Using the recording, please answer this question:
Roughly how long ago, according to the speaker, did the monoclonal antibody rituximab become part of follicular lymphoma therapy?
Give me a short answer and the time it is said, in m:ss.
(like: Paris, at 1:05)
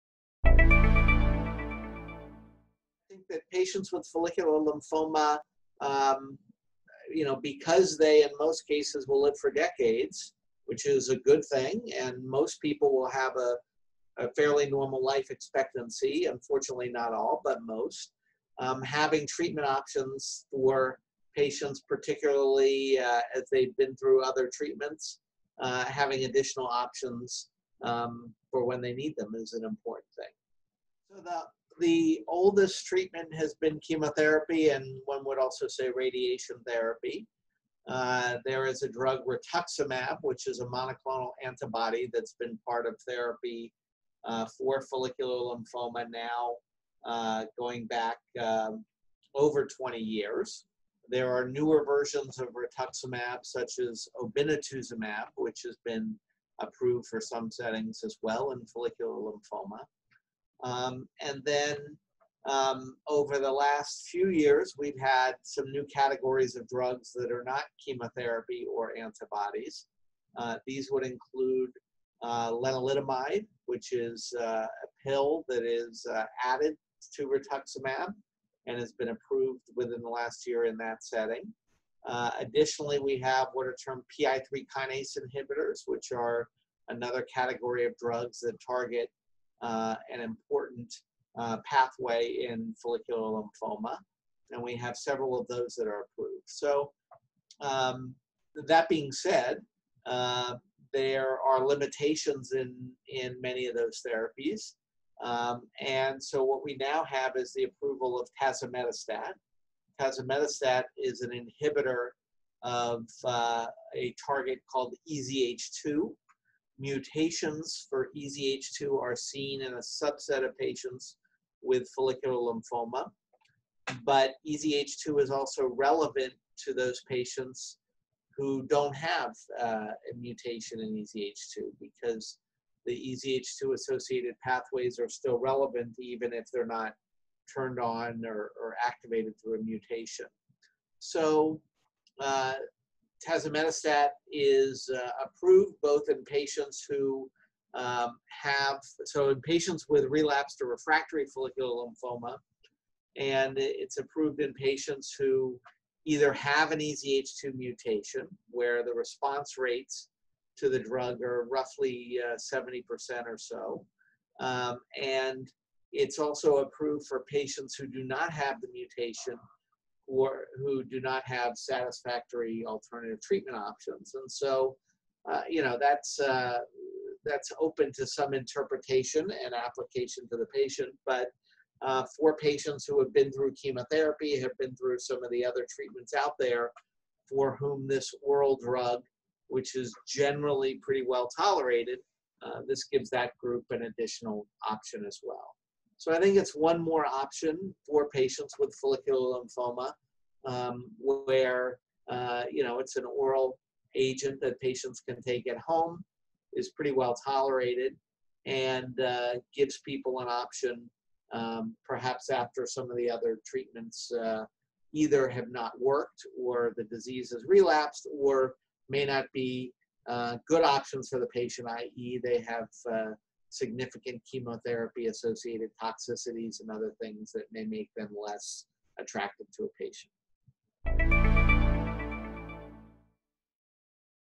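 over 20 years, at 0:49.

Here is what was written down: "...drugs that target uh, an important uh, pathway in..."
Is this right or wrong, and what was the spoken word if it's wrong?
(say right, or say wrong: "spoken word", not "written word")
right.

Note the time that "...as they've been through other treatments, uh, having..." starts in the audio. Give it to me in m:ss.
0:23.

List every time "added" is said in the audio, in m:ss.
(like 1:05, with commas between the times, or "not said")
1:16.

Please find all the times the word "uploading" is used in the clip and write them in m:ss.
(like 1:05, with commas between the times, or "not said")
not said.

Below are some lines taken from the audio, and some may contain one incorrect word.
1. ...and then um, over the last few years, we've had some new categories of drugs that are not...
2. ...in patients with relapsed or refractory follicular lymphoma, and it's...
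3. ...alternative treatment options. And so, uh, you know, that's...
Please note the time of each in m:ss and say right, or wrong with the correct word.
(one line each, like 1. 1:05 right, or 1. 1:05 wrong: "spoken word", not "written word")
1. 1:01 right
2. 2:29 right
3. 2:52 right.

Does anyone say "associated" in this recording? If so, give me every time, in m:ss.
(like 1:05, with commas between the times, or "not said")
2:13, 3:45.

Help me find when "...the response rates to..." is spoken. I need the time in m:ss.
2:38.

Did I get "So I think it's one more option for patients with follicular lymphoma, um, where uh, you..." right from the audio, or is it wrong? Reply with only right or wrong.
right.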